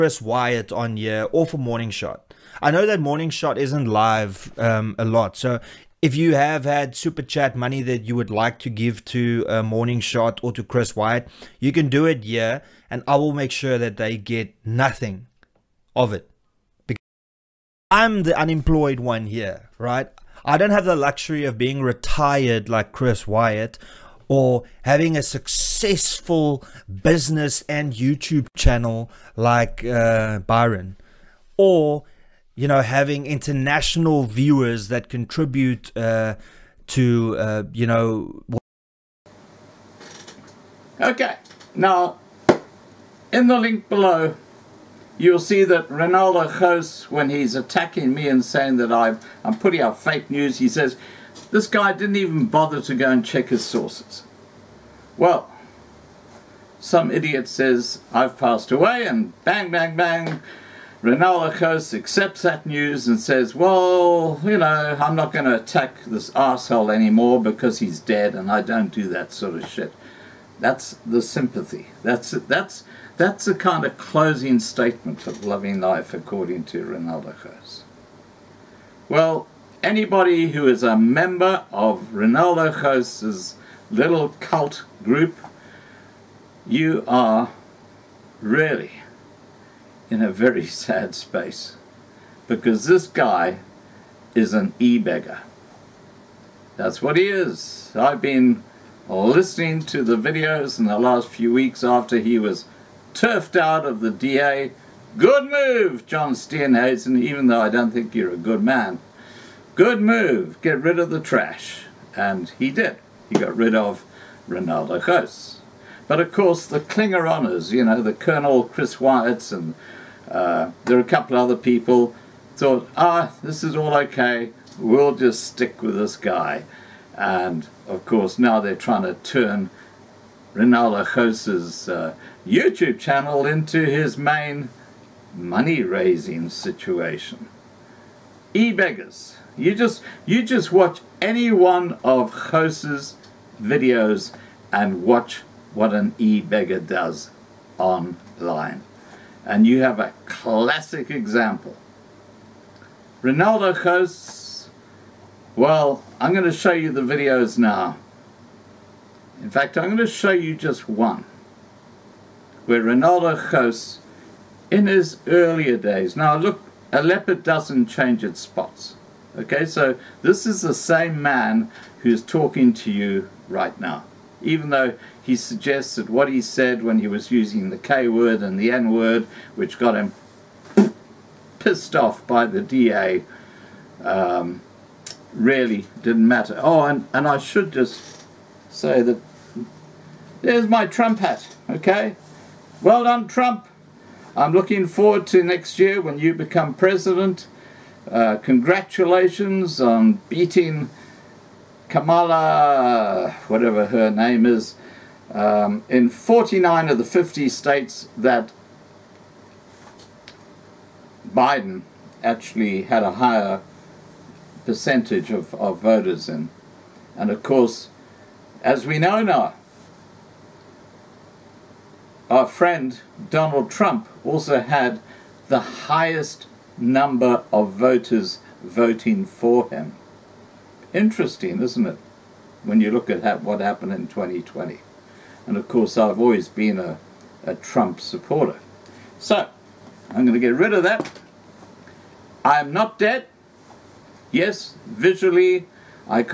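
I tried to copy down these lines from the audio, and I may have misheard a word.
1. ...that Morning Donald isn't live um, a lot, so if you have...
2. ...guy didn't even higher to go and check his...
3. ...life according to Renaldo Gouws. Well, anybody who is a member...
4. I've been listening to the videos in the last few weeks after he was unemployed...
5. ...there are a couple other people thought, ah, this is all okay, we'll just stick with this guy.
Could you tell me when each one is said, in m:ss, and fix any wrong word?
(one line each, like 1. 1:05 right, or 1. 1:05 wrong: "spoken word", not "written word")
1. 0:02 wrong: "Shot", not "Donald"
2. 0:51 wrong: "bother", not "higher"
3. 1:15 right
4. 1:37 wrong: "turfed", not "unemployed"
5. 2:00 right.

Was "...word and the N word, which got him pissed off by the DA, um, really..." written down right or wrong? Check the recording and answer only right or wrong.
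right.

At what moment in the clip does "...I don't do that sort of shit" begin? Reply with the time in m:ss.
1:08.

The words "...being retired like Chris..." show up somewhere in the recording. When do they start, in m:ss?
0:21.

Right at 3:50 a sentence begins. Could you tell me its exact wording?
Interesting, isn't it, when you look at what happened in 2020.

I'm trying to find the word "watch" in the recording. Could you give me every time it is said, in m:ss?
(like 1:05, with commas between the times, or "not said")
2:20, 2:25.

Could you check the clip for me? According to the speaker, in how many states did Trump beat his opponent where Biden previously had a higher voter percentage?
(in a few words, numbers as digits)
49.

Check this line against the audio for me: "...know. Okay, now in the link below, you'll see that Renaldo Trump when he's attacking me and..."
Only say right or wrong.
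wrong.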